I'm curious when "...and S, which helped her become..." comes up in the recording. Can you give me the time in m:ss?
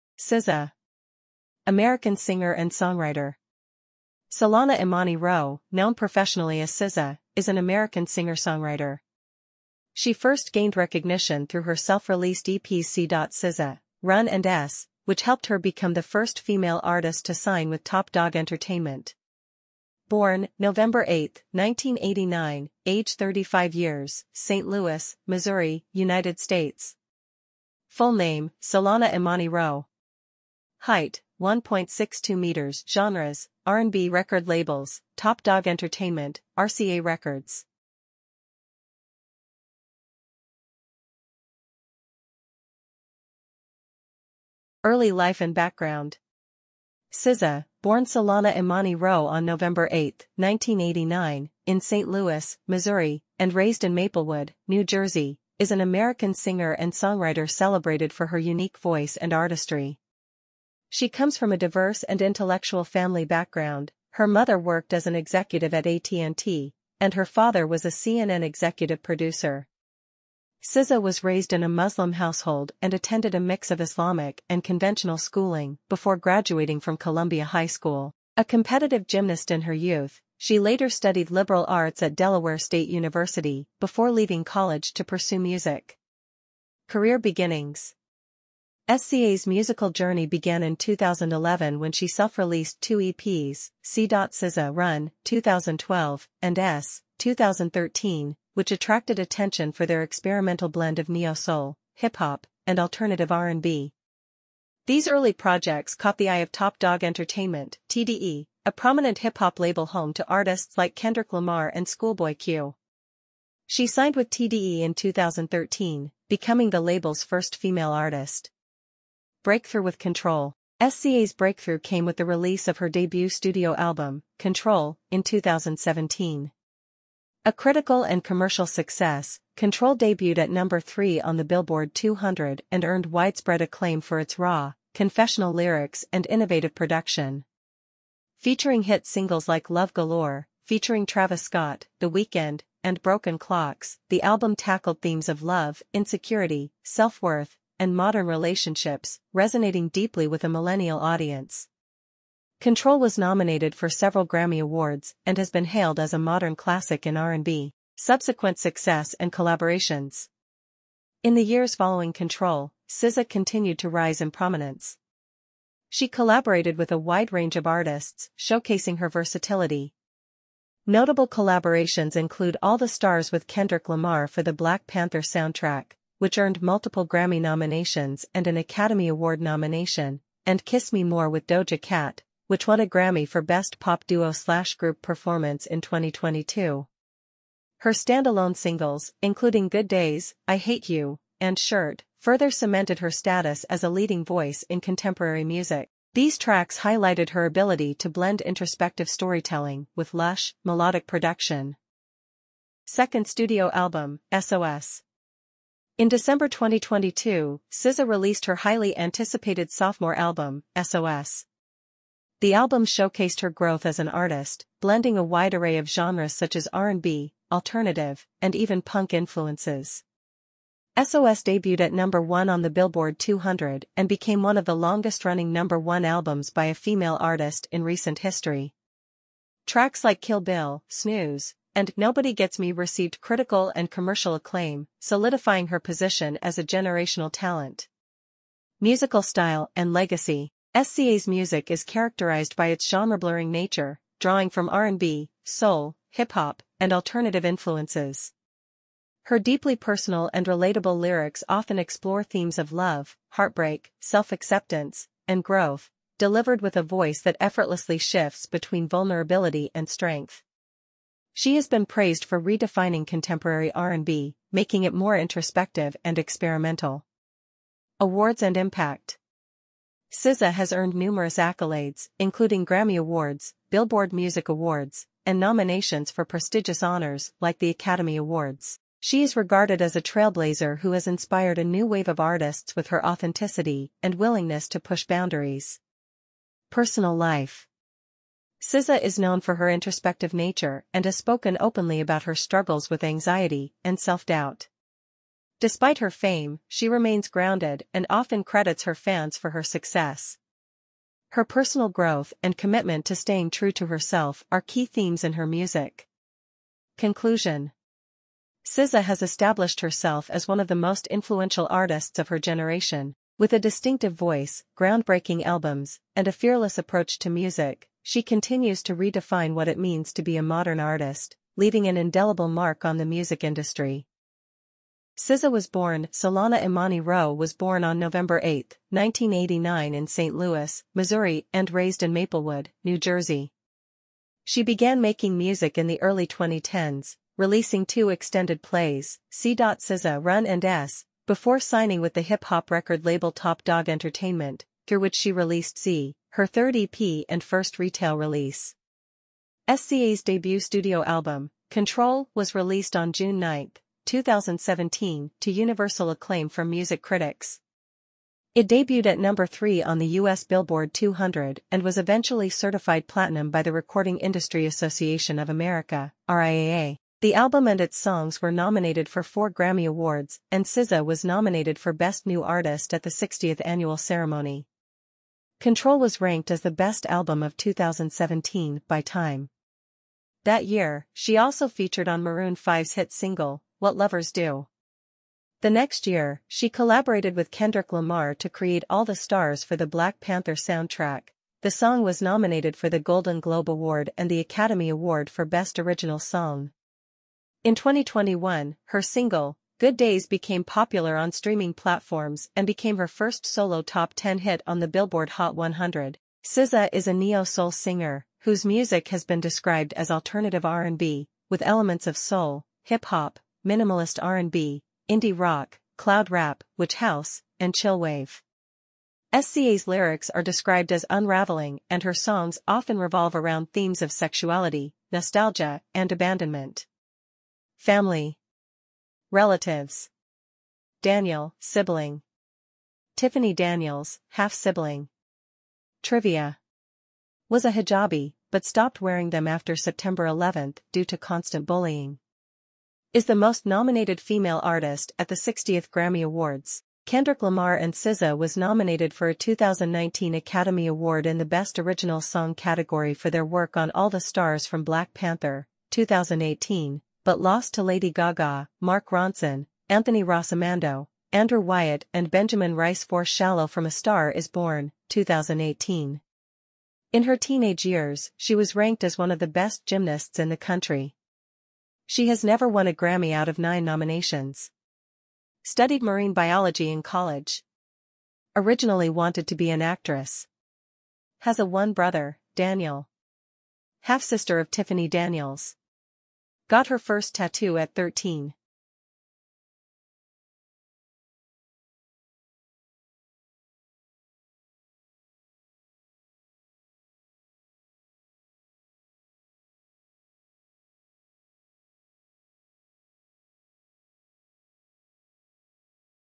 0:14.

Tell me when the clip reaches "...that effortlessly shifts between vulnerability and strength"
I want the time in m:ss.
4:17.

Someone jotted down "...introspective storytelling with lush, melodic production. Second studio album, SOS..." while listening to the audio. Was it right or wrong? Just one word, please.
right.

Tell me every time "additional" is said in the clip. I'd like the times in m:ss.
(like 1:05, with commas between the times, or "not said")
not said.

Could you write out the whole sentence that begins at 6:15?
Ctrl was ranked as the best album of 2017 by Time.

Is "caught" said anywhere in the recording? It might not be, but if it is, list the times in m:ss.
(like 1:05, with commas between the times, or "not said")
1:45.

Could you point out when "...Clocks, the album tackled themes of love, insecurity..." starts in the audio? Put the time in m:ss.
2:23.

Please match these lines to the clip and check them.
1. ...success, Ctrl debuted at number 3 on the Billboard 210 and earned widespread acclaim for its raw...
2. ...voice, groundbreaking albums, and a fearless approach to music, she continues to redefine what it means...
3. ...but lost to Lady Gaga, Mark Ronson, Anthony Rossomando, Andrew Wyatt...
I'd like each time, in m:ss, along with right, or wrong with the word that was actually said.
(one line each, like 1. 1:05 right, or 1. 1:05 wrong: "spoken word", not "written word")
1. 2:08 wrong: "200", not "210"
2. 5:14 right
3. 7:37 right.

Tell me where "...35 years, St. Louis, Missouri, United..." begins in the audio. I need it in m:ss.
0:23.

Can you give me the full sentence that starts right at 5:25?
SZA was born, Solana Imani Rowe was born on November 8, 1989 in St.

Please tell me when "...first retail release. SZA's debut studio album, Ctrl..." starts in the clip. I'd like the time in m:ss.
5:47.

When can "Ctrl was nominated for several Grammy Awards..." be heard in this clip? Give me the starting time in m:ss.
2:32.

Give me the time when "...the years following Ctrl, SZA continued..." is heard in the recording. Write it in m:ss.
2:41.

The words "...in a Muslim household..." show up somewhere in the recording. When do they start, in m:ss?
1:11.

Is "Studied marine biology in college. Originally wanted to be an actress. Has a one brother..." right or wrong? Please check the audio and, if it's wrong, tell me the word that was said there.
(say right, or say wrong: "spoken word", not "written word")
right.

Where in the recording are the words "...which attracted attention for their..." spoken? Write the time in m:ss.
1:38.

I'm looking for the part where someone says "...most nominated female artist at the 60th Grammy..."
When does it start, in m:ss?
7:23.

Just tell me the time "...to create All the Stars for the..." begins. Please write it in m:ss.
6:28.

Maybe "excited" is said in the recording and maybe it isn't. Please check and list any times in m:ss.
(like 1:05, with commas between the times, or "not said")
not said.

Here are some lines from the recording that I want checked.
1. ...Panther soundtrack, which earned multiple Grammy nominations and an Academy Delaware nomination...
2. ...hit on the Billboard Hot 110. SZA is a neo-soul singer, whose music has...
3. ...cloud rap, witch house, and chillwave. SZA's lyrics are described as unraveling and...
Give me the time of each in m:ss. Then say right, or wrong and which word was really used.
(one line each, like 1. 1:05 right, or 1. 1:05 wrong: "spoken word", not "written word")
1. 2:54 wrong: "Award", not "Delaware"
2. 6:44 wrong: "100", not "110"
3. 6:55 right.